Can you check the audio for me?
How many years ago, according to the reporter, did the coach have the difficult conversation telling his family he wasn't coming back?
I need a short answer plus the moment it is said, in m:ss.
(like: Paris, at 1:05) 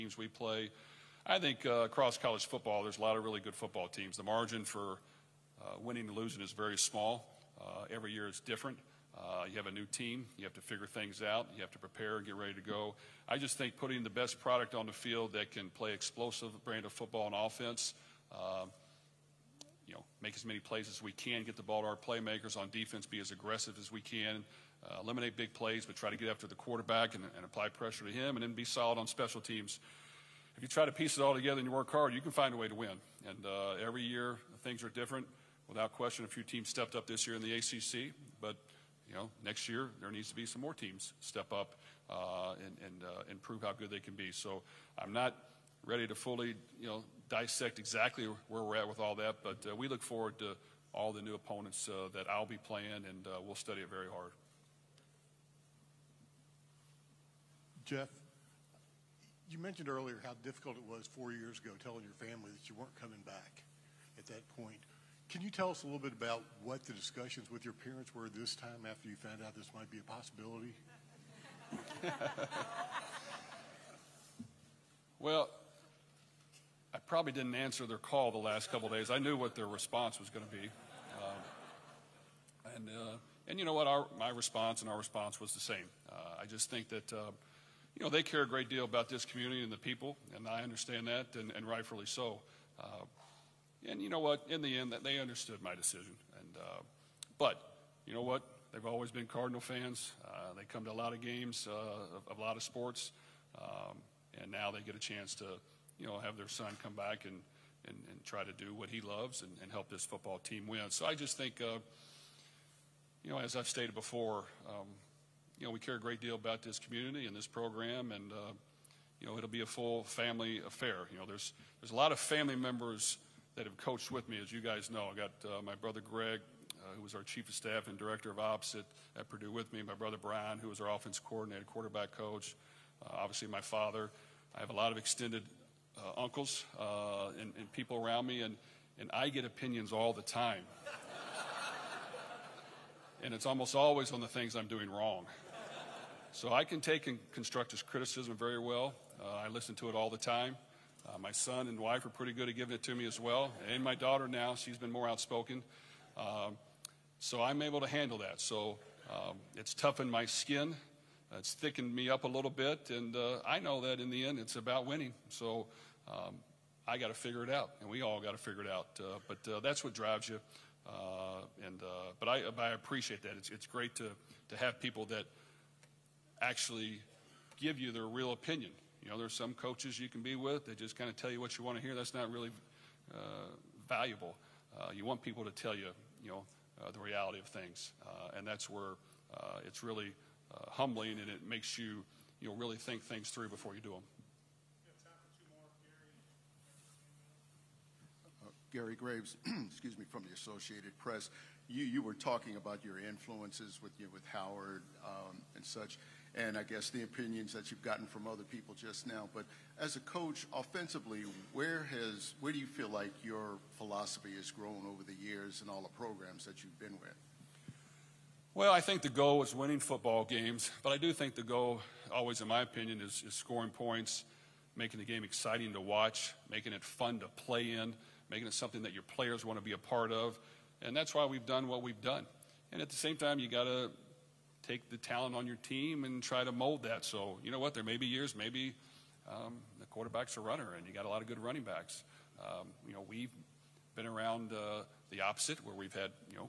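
4, at 1:01.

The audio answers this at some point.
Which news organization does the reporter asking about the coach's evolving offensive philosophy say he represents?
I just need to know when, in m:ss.
3:20.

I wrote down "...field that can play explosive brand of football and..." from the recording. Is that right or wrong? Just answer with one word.
right.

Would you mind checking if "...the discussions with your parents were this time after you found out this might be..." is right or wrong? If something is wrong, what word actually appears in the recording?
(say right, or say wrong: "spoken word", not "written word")
right.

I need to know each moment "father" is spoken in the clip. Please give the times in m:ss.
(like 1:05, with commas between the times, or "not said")
2:13.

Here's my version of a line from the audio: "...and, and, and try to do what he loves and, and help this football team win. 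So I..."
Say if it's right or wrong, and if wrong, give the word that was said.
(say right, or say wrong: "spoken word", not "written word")
right.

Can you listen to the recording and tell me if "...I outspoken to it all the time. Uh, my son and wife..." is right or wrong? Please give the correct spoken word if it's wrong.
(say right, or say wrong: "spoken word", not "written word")
wrong: "listen", not "outspoken".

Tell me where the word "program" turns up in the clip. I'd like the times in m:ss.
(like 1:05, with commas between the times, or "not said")
1:57, 3:35.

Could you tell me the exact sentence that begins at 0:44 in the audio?
So I'm not ready to fully, you know, dissect exactly where we're at with all that.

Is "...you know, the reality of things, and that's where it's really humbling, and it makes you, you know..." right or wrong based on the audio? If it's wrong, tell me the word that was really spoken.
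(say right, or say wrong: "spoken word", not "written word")
right.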